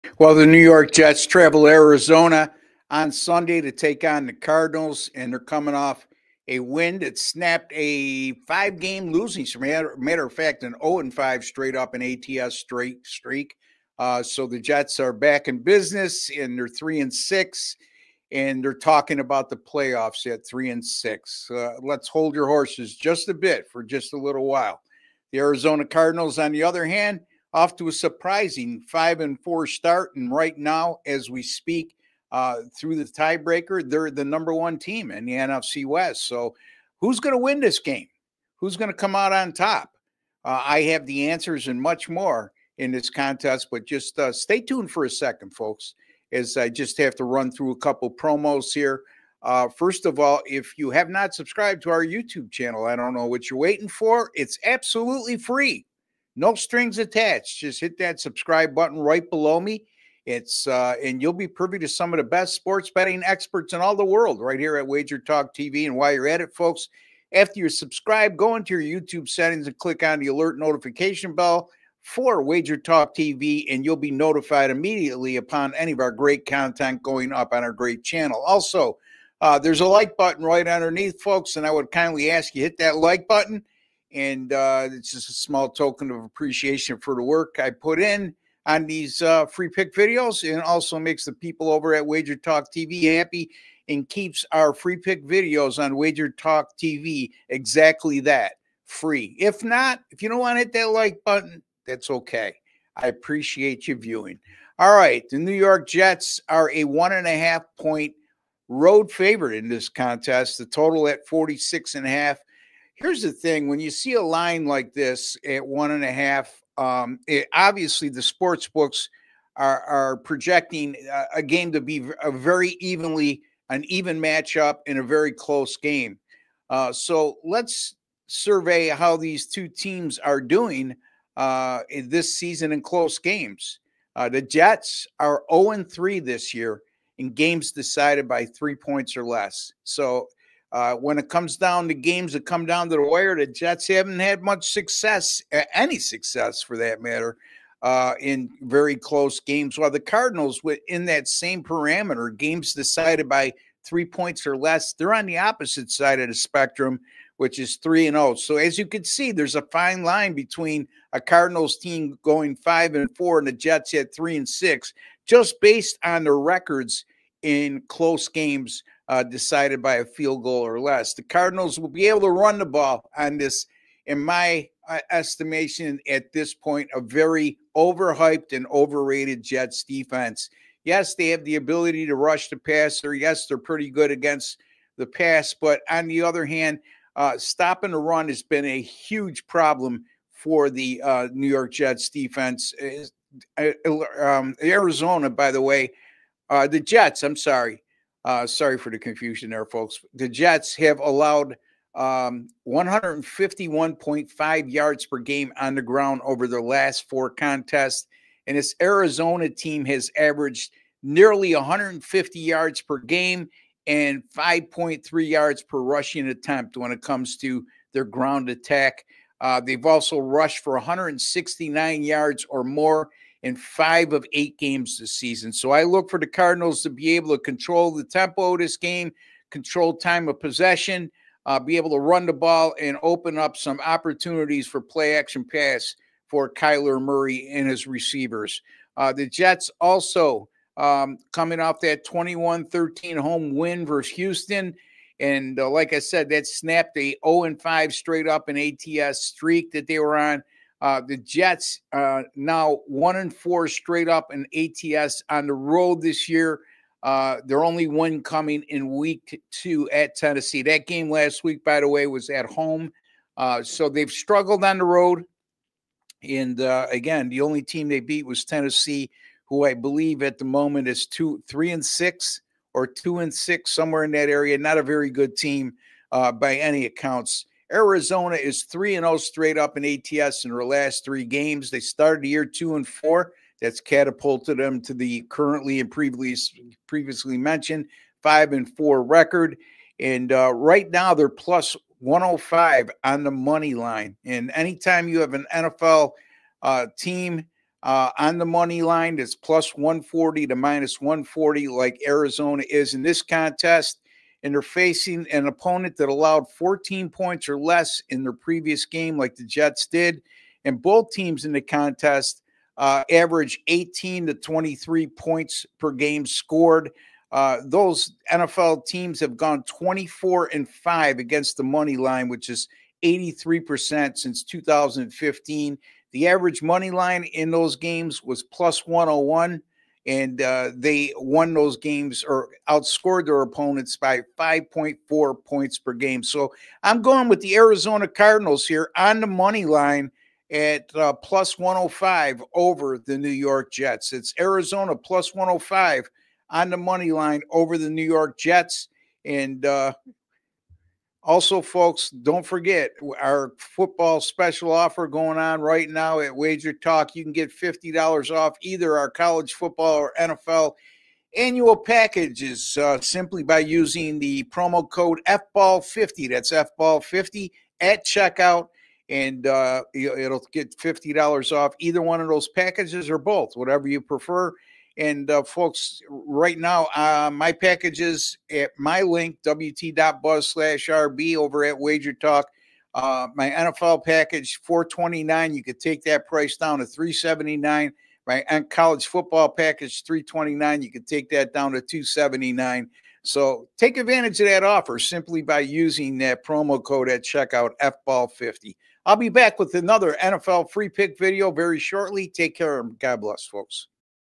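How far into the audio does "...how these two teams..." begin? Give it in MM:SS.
02:08.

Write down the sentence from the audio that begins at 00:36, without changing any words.
So, who's going to win this game?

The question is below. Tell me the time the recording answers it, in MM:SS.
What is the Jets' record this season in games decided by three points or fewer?
02:15.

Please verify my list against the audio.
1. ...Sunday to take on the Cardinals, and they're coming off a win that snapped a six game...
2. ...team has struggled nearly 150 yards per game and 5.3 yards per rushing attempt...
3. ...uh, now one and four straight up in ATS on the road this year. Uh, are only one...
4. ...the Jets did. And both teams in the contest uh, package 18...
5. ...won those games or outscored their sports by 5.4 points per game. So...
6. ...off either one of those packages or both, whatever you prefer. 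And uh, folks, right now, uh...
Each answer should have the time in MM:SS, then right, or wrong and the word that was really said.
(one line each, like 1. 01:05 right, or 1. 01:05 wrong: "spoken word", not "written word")
1. 00:03 wrong: "five", not "six"
2. 03:29 wrong: "averaged", not "struggled"
3. 04:11 right
4. 05:09 wrong: "average", not "package"
5. 05:31 wrong: "opponents", not "sports"
6. 06:11 right.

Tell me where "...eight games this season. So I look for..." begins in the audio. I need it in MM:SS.
03:44.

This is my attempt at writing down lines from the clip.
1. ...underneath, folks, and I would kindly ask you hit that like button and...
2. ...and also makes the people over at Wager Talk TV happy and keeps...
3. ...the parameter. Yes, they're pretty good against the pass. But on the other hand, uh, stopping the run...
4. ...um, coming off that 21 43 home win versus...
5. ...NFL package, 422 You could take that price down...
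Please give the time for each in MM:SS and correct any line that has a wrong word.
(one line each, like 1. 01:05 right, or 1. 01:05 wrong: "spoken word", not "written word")
1. 01:20 right
2. 01:30 right
3. 03:02 wrong: "passer", not "parameter"
4. 04:00 wrong: "13", not "43"
5. 06:23 wrong: "429", not "422".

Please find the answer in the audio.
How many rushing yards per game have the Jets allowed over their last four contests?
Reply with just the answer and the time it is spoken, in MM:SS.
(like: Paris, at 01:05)
151.5, at 03:22.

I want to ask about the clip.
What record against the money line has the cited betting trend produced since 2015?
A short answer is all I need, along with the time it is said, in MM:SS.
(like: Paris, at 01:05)
24-5, at 05:19.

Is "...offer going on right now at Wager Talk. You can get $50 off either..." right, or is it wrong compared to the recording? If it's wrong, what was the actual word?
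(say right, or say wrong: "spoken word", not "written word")
right.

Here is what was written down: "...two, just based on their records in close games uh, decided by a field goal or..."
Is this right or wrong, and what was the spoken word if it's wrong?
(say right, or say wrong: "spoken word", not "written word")
wrong: "six", not "two".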